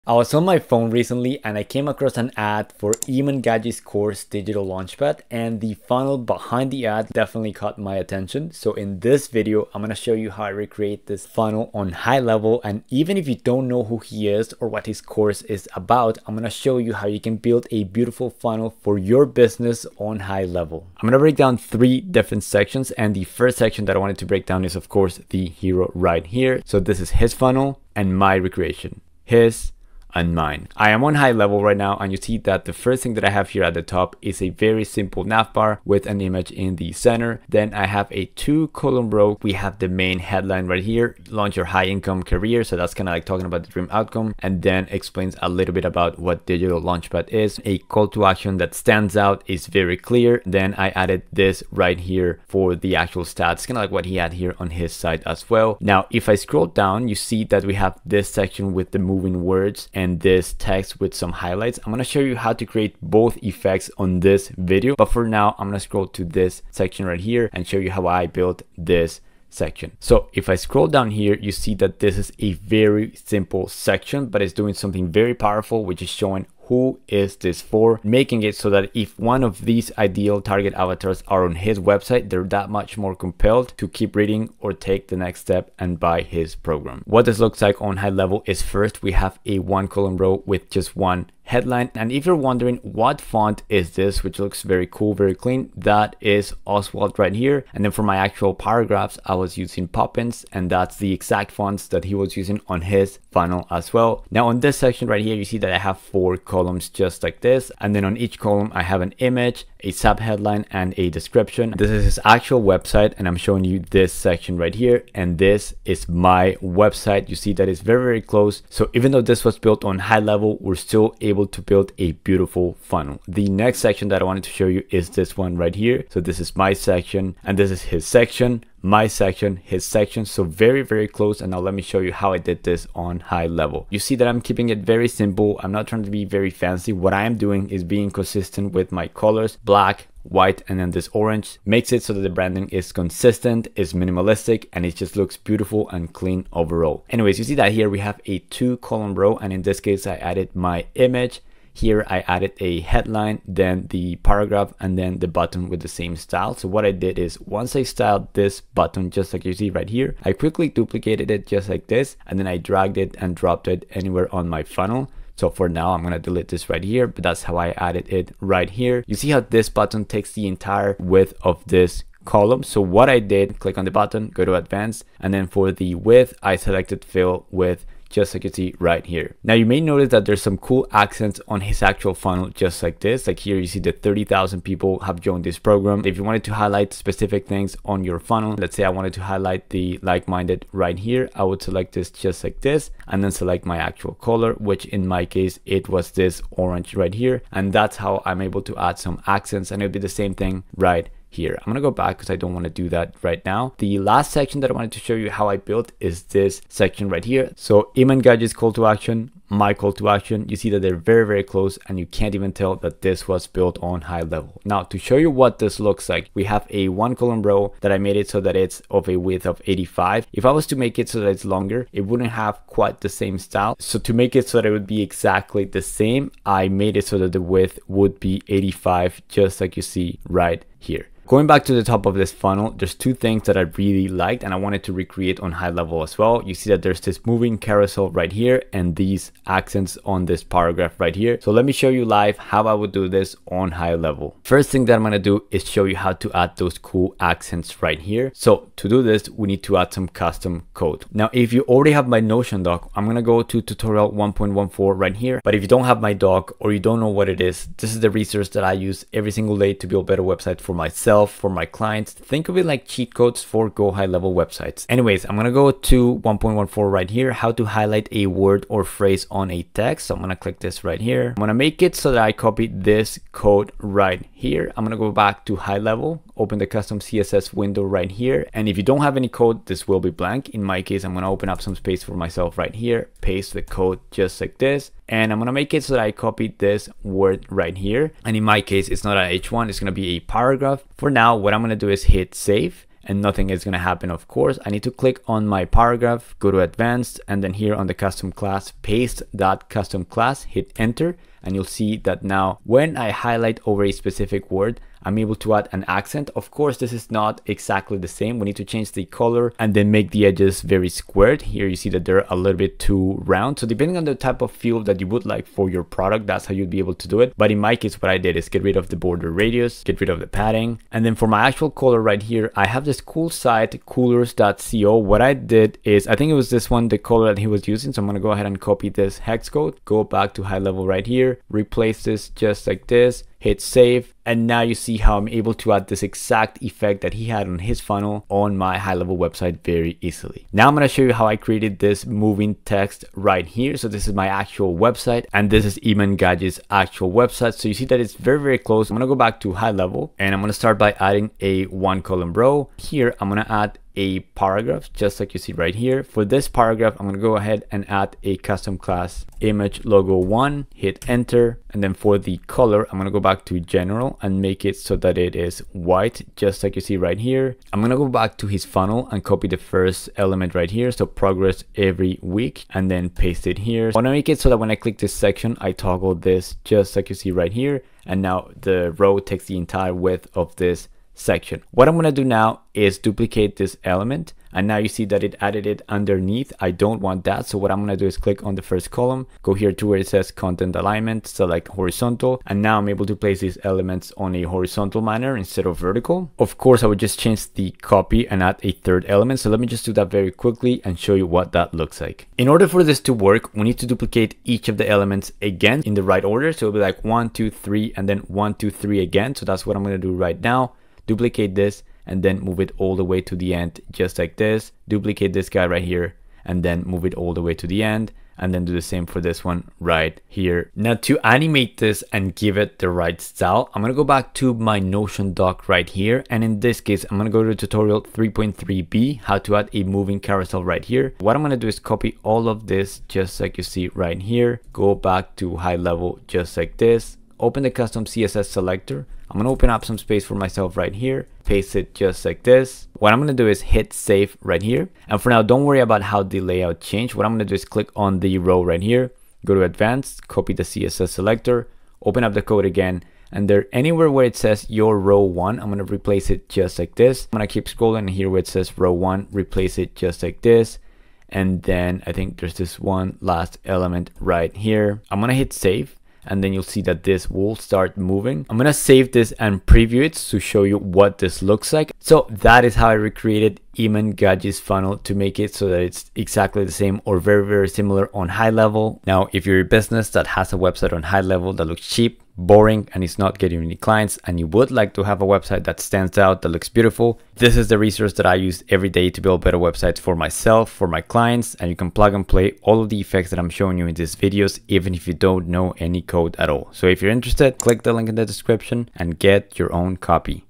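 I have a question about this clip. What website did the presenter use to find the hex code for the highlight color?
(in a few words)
coolors.co.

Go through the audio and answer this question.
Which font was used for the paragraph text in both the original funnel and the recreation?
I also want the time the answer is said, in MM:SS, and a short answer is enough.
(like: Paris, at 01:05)
Poppins, at 01:39.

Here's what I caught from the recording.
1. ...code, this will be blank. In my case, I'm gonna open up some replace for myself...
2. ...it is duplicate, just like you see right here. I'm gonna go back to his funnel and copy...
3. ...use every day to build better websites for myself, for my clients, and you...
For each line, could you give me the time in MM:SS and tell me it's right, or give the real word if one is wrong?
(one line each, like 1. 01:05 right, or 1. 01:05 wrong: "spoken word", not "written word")
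1. 04:39 wrong: "space", not "replace"
2. 06:05 wrong: "white", not "duplicate"
3. 08:08 right.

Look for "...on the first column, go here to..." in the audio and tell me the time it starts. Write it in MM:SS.
06:28.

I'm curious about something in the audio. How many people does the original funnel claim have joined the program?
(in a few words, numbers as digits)
30,000.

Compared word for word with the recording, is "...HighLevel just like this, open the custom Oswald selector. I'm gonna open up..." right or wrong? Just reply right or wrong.
wrong.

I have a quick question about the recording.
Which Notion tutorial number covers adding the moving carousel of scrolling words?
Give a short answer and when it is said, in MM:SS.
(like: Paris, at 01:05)
3.3b, at 07:08.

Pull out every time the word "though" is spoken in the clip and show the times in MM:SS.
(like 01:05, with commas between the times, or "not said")
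01:59.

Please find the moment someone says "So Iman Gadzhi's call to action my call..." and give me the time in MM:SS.
03:27.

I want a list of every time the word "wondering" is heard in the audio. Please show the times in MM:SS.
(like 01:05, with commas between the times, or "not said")
01:32.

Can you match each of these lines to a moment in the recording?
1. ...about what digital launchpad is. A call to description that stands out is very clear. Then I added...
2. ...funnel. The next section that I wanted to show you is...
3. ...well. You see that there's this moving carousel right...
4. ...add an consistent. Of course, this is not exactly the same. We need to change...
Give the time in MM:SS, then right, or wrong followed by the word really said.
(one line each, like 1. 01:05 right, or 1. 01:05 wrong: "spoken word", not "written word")
1. 00:45 wrong: "action", not "description"
2. 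02:02 right
3. 03:56 right
4. 05:05 wrong: "accent", not "consistent".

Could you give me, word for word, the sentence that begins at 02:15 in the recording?
I'm not trying to be very fancy.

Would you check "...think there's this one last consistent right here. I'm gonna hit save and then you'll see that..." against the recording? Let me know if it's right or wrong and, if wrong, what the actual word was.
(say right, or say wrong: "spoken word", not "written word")
wrong: "element", not "consistent".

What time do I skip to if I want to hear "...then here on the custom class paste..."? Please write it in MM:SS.
04:57.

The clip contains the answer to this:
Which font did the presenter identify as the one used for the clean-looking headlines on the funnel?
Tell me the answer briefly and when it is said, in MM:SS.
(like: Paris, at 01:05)
Oswald, at 01:36.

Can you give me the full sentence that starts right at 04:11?
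Now, if you already have my Notion doc, I'm going to go to tutorial 1.14 right here.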